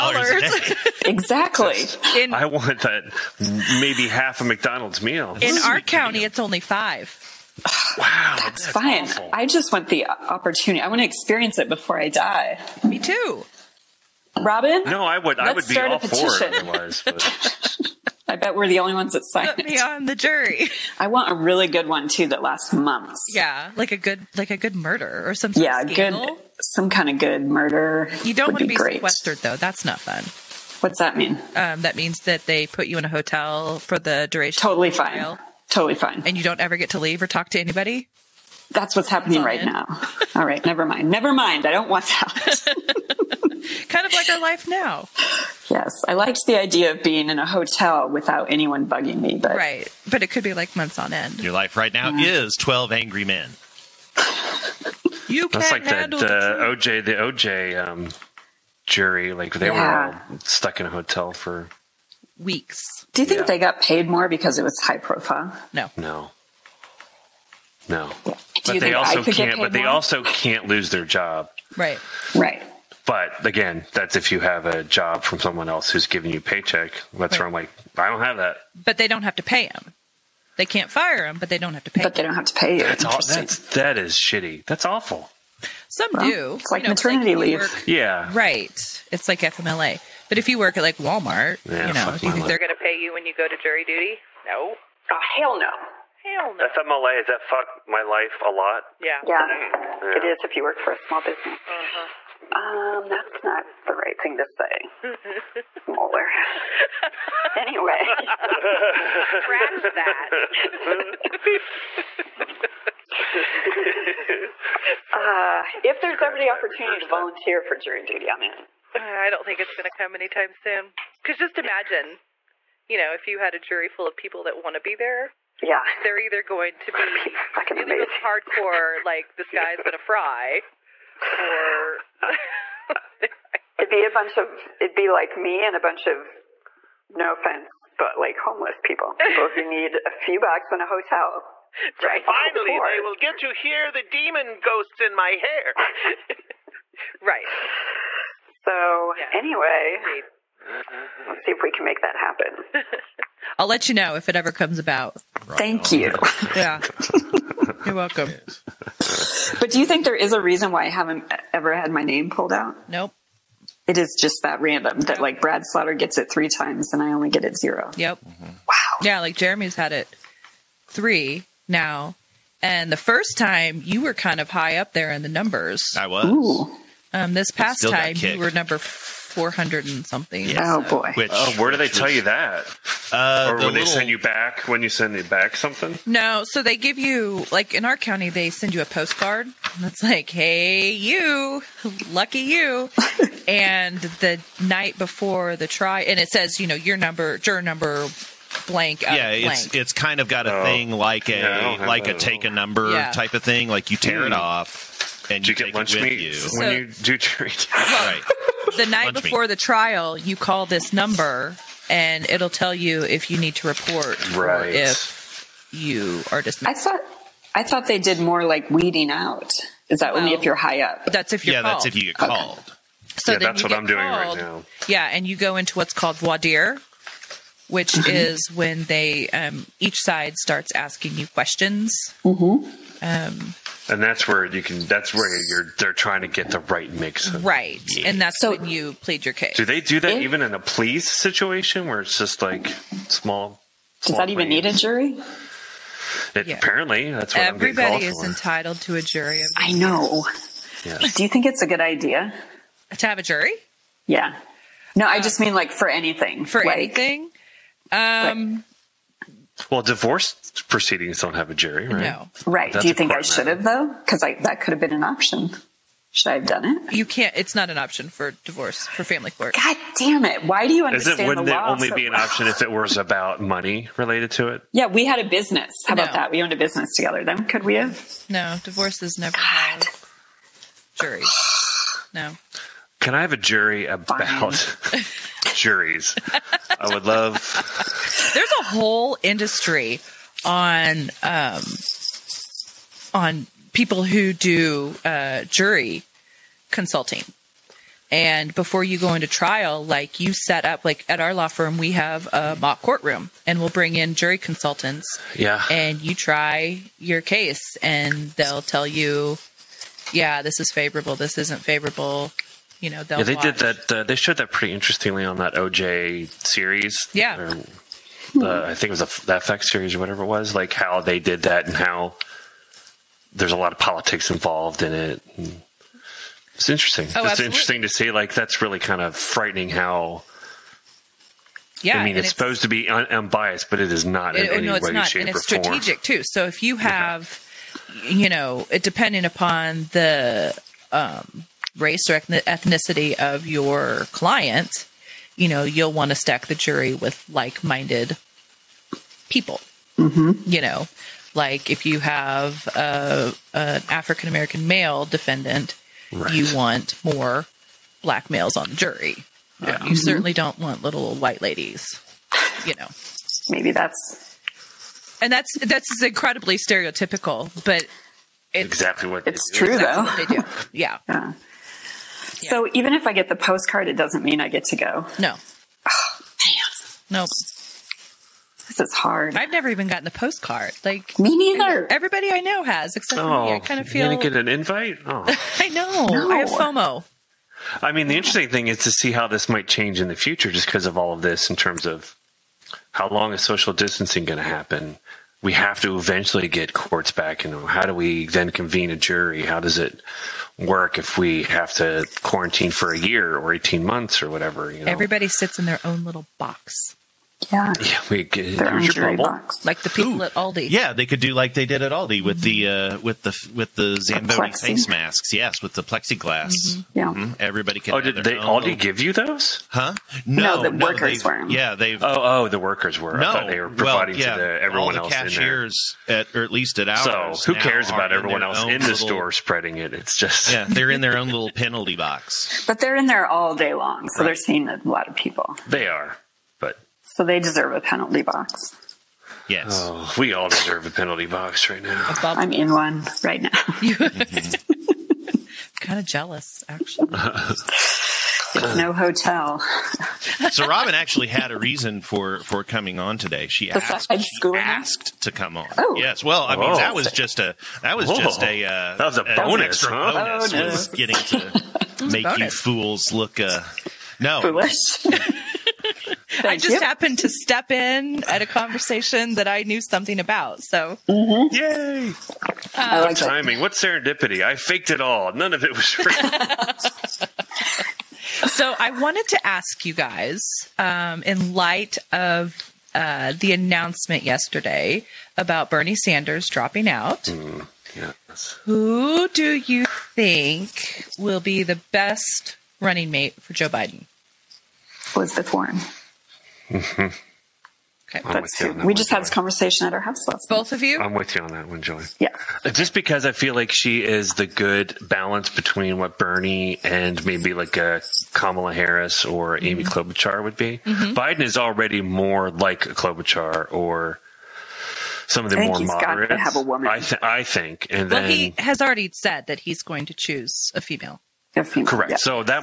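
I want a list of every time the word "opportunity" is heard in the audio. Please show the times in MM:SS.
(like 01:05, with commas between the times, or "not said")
00:10, 01:56.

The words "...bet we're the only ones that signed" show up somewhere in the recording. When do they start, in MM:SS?
00:18.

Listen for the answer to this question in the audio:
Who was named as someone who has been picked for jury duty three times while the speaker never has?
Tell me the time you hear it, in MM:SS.
02:45.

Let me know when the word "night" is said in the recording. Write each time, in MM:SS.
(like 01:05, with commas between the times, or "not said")
03:14, 03:28.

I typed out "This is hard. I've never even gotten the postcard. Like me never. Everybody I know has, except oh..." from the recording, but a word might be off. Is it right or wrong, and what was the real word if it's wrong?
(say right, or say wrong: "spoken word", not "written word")
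wrong: "neither", not "never".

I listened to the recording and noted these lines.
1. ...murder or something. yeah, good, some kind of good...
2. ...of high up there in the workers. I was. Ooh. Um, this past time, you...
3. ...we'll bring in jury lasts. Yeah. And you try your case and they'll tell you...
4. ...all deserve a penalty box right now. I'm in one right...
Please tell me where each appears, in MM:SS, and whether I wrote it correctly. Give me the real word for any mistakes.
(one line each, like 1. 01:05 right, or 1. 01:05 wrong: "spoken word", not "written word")
1. 00:24 right
2. 02:54 wrong: "numbers", not "workers"
3. 05:03 wrong: "consultants", not "lasts"
4. 07:20 right.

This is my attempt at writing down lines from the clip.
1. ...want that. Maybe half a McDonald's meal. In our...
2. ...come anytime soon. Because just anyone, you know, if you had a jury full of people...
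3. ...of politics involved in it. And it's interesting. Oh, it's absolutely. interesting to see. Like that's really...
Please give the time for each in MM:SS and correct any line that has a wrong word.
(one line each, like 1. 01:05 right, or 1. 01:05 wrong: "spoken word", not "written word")
1. 00:02 right
2. 01:59 wrong: "imagine", not "anyone"
3. 05:23 right.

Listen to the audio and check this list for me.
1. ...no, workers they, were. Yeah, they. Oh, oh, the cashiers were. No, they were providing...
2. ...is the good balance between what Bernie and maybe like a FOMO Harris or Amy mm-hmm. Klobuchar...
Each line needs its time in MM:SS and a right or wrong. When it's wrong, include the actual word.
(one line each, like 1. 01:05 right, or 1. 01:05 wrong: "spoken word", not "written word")
1. 07:00 wrong: "workers", not "cashiers"
2. 08:24 wrong: "Kamala", not "FOMO".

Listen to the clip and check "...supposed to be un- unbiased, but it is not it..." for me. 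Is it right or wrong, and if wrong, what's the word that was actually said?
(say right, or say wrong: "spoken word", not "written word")
right.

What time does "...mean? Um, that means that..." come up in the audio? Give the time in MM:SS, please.
00:31.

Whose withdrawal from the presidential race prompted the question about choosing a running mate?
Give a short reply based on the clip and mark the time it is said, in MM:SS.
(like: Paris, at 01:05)
Bernie Sanders, at 08:05.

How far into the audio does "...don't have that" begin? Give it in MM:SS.
01:18.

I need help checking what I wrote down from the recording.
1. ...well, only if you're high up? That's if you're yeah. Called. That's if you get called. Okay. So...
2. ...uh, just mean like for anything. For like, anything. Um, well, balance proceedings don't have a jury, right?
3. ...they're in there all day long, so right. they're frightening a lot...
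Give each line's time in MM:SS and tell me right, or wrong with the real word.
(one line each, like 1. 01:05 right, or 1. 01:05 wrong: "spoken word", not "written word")
1. 03:40 right
2. 04:15 wrong: "divorce", not "balance"
3. 07:12 wrong: "seeing", not "frightening".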